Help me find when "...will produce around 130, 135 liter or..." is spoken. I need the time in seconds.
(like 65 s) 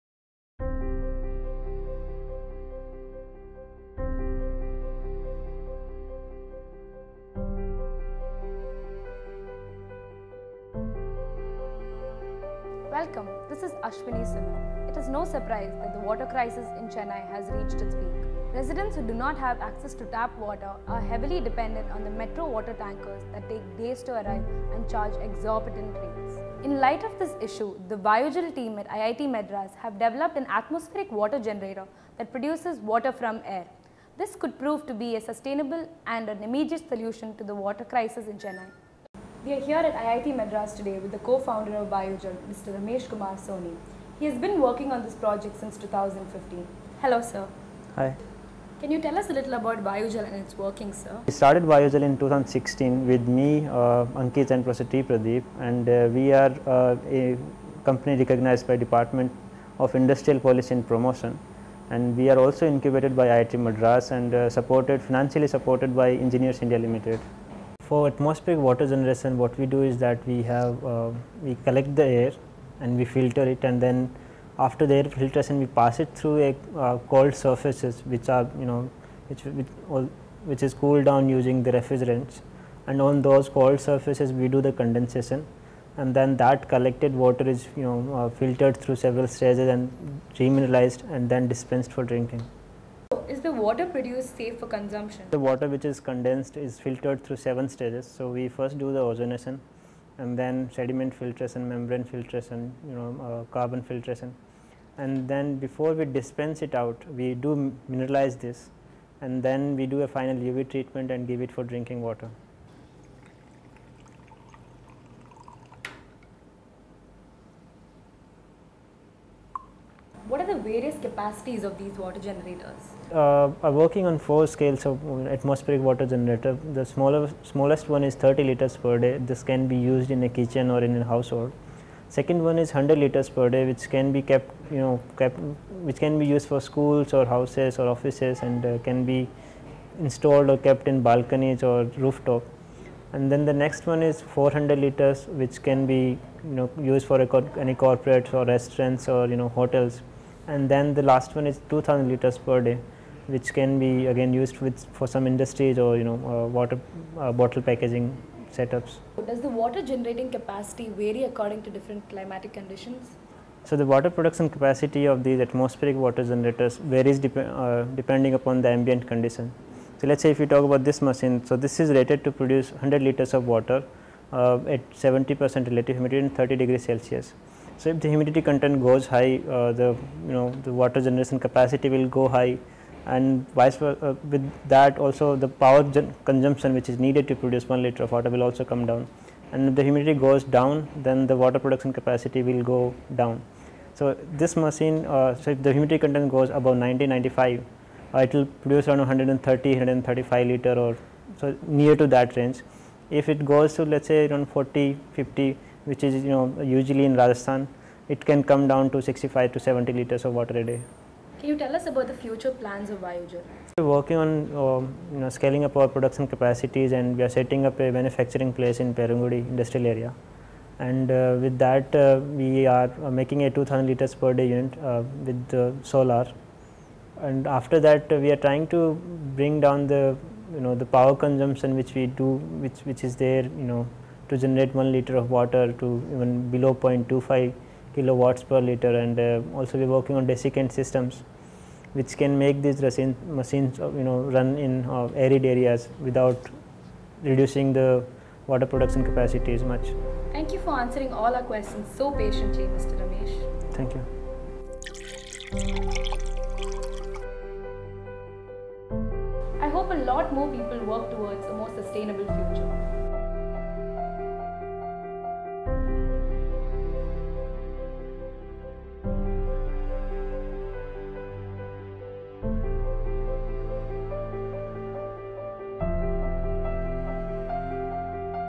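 198 s.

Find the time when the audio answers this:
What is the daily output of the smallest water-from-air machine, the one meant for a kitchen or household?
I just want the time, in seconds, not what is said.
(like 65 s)
128 s.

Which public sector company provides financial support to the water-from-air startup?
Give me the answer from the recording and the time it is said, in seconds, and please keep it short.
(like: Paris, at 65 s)
Engineers India Limited, at 66 s.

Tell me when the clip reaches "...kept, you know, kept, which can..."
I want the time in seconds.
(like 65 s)
134 s.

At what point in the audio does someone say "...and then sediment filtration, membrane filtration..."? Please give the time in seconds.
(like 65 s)
100 s.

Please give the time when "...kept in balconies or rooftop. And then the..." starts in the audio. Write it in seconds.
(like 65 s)
140 s.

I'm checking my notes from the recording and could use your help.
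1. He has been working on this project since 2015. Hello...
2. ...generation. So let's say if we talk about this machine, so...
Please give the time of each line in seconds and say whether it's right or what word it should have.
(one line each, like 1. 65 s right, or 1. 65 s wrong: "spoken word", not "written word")
1. 44 s right
2. 169 s wrong: "condition", not "generation".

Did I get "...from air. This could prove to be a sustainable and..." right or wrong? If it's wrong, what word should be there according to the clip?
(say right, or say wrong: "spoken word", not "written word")
right.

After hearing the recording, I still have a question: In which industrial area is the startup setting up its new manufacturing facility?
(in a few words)
Perungudi.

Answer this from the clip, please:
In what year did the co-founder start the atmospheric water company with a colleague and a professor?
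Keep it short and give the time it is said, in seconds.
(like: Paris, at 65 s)
2016, at 52 s.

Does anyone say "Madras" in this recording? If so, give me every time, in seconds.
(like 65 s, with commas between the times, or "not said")
29 s, 40 s, 63 s.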